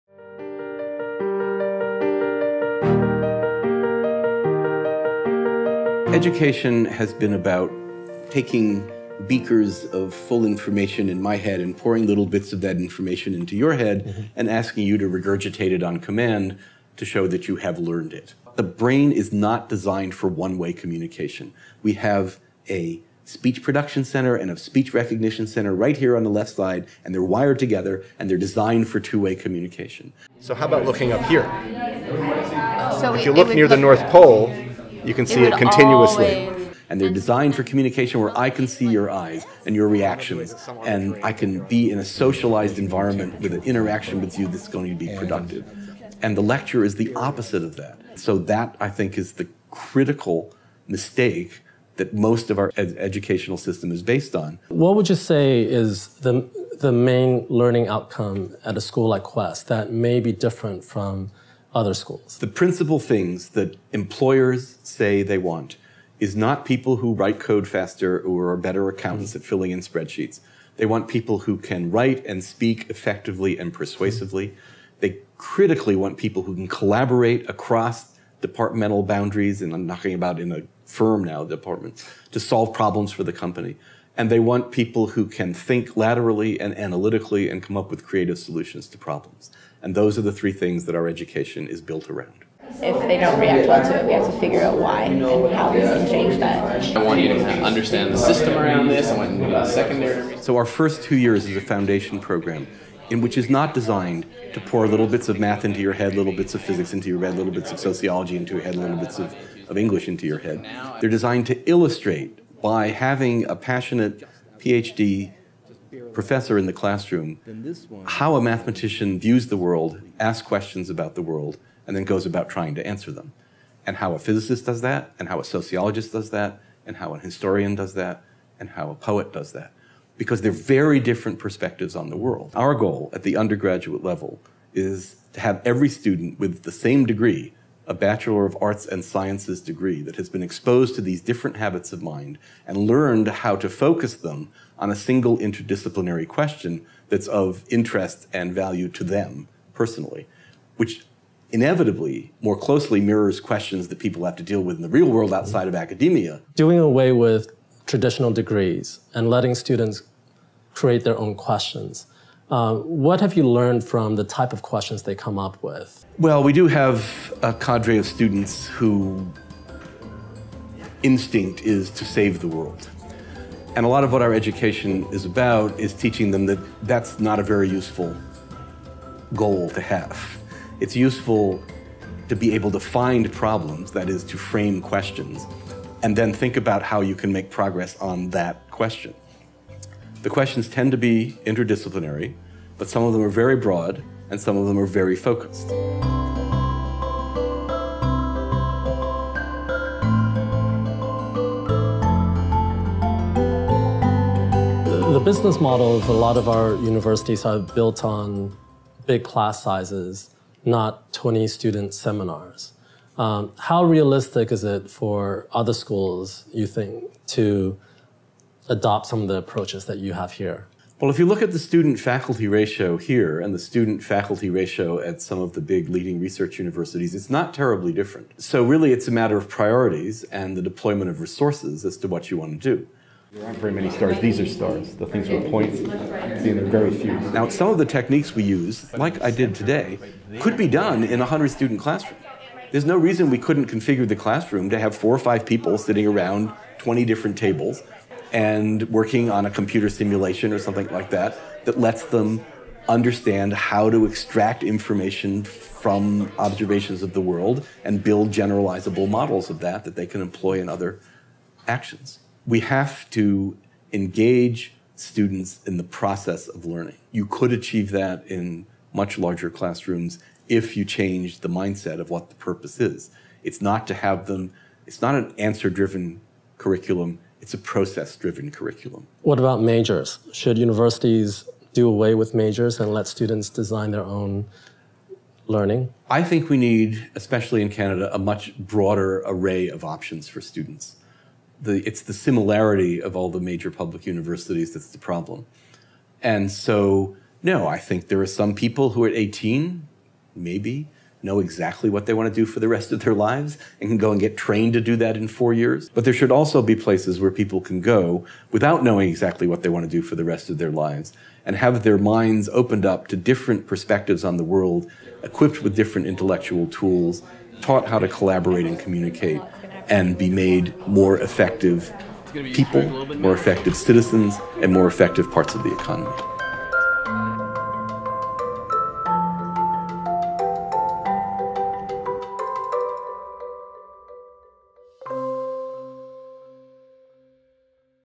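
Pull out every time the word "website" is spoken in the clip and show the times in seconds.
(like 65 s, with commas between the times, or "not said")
not said.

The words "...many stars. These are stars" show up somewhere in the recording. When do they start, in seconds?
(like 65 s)
233 s.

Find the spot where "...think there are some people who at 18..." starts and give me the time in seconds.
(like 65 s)
297 s.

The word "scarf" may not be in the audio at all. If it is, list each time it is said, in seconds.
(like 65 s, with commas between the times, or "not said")
not said.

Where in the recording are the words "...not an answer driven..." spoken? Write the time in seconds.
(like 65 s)
275 s.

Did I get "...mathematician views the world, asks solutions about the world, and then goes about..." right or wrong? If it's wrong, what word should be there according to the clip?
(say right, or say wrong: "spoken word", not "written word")
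wrong: "questions", not "solutions".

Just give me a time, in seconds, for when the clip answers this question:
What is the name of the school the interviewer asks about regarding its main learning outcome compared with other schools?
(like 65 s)
59 s.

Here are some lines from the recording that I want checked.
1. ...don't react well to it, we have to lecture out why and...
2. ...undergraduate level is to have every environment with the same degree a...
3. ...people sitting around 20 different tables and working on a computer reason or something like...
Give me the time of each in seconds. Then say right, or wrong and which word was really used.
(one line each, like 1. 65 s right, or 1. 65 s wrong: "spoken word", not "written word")
1. 93 s wrong: "figure", not "lecture"
2. 133 s wrong: "student", not "environment"
3. 245 s wrong: "simulation", not "reason".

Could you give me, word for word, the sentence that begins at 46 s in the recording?
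And the lecture is the opposite of that.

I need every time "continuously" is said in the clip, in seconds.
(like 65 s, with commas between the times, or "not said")
35 s.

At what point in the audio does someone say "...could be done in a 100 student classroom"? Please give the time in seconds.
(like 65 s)
240 s.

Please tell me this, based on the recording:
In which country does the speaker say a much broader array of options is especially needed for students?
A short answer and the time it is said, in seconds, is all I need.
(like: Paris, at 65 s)
Canada, at 287 s.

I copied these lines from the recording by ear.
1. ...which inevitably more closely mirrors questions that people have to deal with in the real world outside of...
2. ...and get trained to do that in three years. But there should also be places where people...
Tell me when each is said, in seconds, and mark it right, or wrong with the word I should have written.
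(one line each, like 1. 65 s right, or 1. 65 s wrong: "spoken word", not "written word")
1. 150 s right
2. 304 s wrong: "four", not "three".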